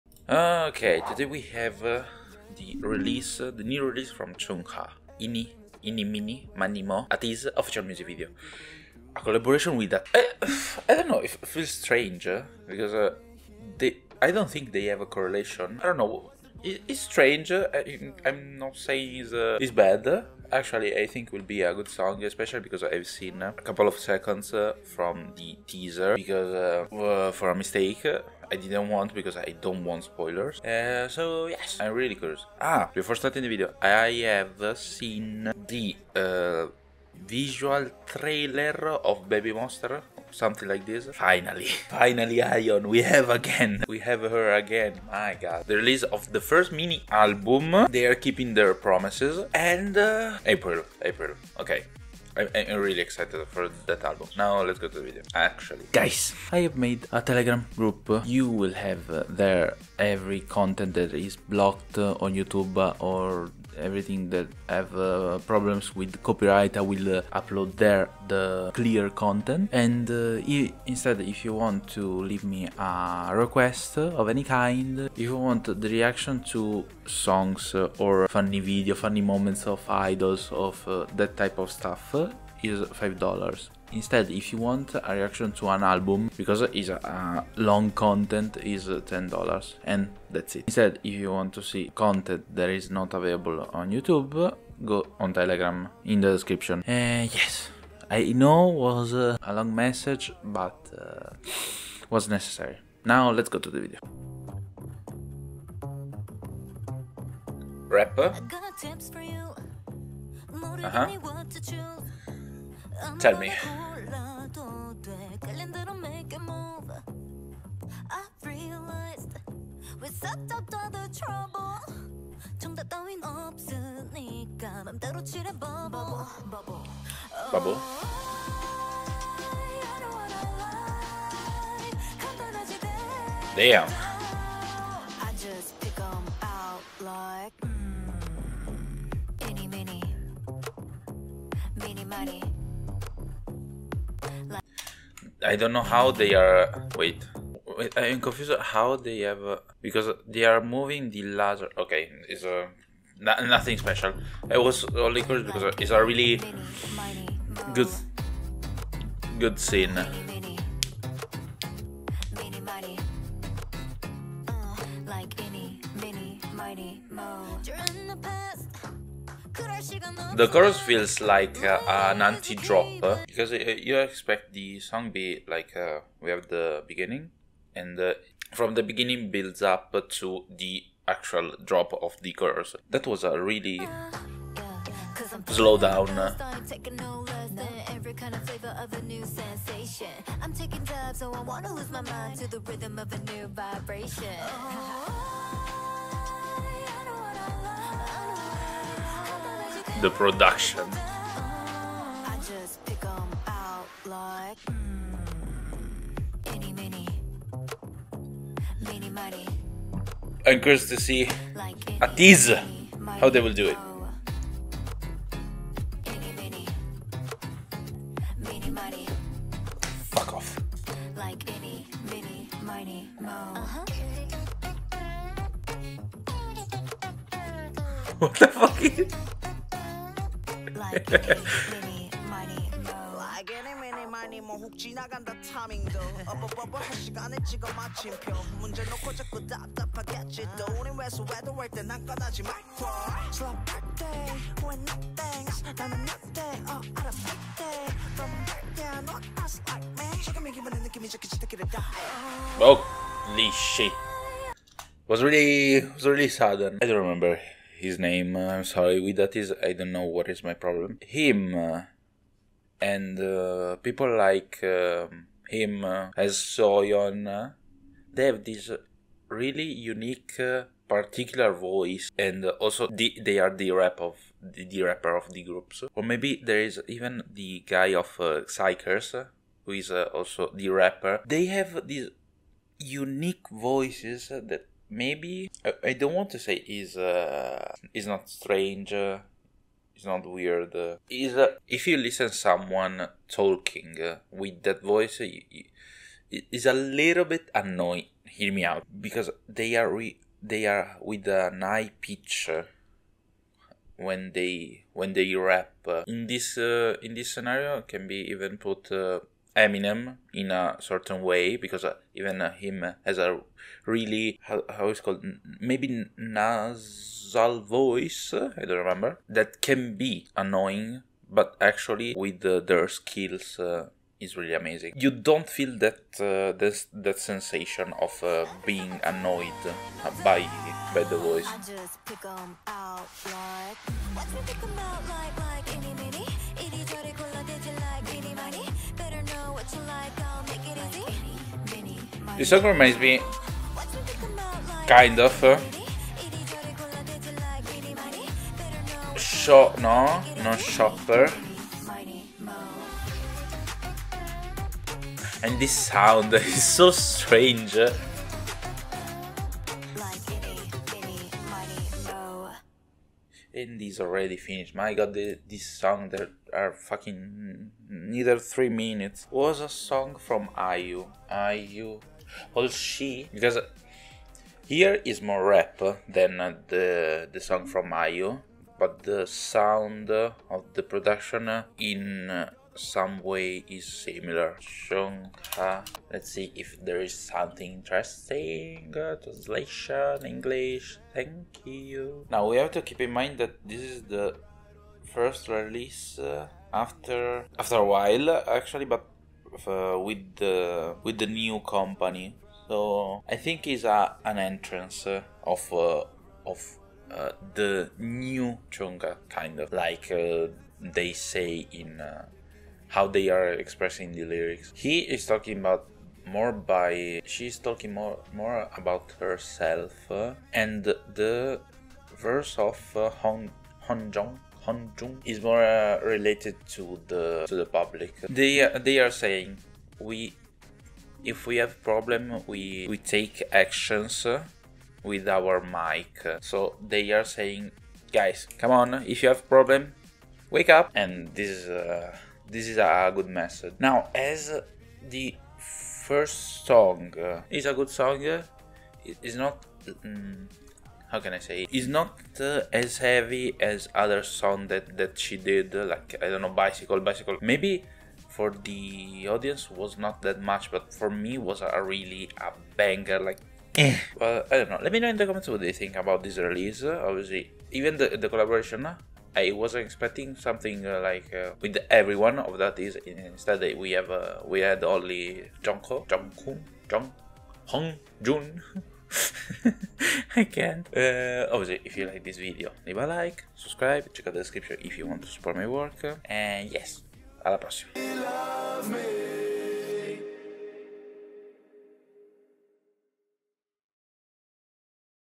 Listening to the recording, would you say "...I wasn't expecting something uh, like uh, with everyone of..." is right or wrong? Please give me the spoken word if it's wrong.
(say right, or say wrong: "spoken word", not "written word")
right.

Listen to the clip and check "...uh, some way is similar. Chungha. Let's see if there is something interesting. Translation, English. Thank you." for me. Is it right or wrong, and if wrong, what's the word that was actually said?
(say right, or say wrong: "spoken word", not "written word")
right.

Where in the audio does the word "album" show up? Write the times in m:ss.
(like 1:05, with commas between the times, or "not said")
0:47, 0:54, 1:25.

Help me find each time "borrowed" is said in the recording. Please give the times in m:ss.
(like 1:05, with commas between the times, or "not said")
not said.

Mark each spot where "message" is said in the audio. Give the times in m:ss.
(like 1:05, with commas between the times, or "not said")
1:39, 7:23.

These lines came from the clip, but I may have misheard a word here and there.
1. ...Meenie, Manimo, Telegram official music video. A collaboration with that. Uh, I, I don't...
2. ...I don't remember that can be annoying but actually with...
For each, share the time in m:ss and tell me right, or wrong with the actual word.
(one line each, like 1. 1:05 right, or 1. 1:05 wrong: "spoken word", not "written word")
1. 0:06 wrong: "ATEEZ", not "Telegram"
2. 5:18 right.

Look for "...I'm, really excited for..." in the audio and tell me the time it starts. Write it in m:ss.
0:52.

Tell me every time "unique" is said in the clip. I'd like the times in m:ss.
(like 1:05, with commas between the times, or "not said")
4:29, 4:42.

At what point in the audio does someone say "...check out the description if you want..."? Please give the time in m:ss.
8:04.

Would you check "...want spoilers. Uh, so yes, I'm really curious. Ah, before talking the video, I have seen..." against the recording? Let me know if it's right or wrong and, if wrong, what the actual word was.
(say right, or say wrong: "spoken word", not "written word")
wrong: "starting", not "talking".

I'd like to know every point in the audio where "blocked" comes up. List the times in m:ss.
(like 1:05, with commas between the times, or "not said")
1:01.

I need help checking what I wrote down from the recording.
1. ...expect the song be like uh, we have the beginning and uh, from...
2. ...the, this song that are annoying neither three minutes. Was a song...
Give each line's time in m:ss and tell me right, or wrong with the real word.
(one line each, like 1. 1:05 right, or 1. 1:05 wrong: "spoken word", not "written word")
1. 2:53 right
2. 6:05 wrong: "fucking", not "annoying".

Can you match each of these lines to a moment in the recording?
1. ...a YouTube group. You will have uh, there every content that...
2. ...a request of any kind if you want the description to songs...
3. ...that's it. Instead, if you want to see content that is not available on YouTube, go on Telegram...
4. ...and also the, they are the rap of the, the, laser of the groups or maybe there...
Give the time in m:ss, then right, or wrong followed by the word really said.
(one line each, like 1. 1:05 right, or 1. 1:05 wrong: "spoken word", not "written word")
1. 0:57 wrong: "Telegram", not "YouTube"
2. 1:12 wrong: "reaction", not "description"
3. 1:30 right
4. 4:32 wrong: "rapper", not "laser".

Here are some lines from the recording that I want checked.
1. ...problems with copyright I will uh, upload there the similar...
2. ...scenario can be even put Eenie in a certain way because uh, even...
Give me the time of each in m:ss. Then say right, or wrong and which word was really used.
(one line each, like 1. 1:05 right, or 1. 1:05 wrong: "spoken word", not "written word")
1. 1:05 wrong: "clear", not "similar"
2. 5:07 wrong: "Eminem", not "Eenie".